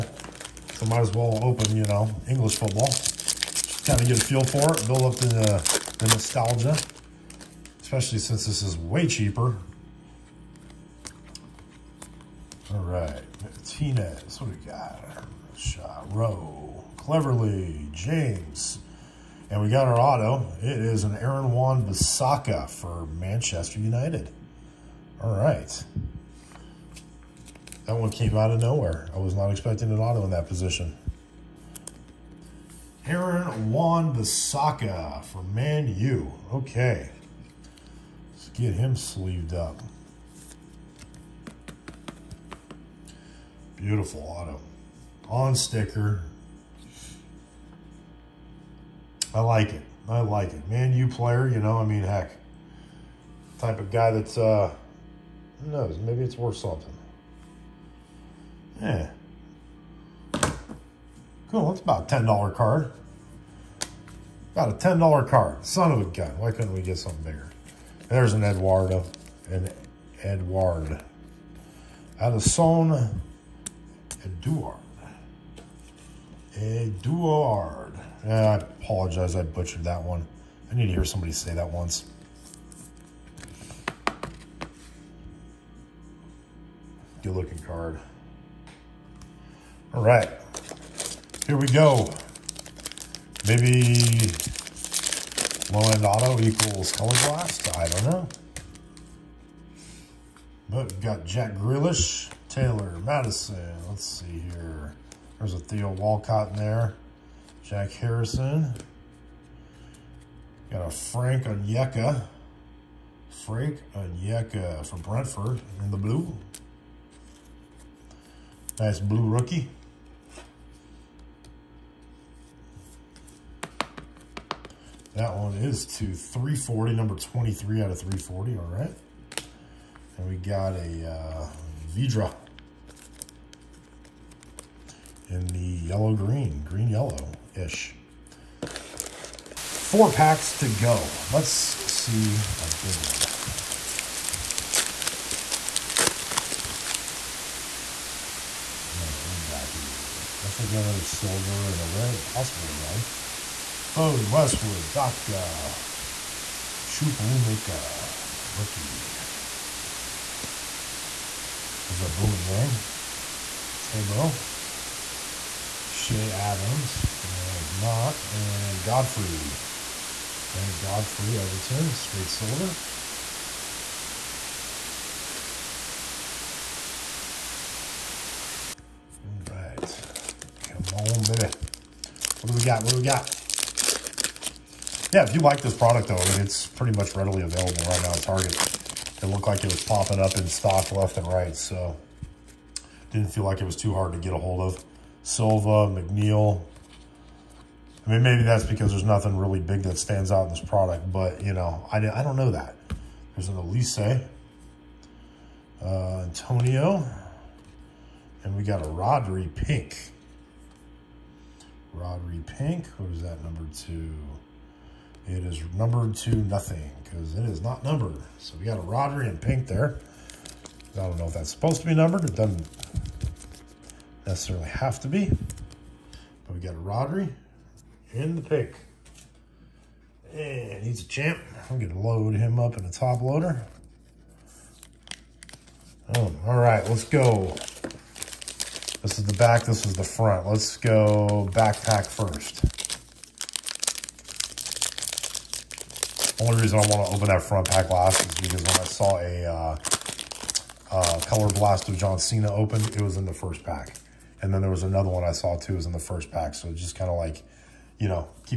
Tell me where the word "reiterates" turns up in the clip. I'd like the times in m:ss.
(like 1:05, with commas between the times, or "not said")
not said.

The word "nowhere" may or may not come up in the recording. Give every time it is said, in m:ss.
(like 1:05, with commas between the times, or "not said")
0:28.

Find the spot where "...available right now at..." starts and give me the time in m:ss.
3:07.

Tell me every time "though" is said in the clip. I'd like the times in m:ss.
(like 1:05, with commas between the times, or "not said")
3:06.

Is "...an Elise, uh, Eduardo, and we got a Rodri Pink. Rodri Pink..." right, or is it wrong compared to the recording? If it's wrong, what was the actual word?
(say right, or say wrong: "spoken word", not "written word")
wrong: "Antonio", not "Eduardo".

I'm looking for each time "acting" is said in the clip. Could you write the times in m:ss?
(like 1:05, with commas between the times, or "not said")
not said.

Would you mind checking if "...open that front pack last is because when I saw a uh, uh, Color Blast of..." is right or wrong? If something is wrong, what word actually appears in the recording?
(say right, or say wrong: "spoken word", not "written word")
right.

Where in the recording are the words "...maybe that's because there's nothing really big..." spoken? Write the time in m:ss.
3:18.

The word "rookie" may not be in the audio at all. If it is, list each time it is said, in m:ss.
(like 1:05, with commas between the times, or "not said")
1:59, 2:38.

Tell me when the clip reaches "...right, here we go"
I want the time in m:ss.
1:30.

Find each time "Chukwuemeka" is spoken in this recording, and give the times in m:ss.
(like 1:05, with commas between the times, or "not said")
2:36.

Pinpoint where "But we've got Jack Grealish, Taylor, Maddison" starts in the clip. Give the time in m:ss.
1:40.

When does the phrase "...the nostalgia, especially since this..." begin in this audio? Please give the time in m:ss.
0:05.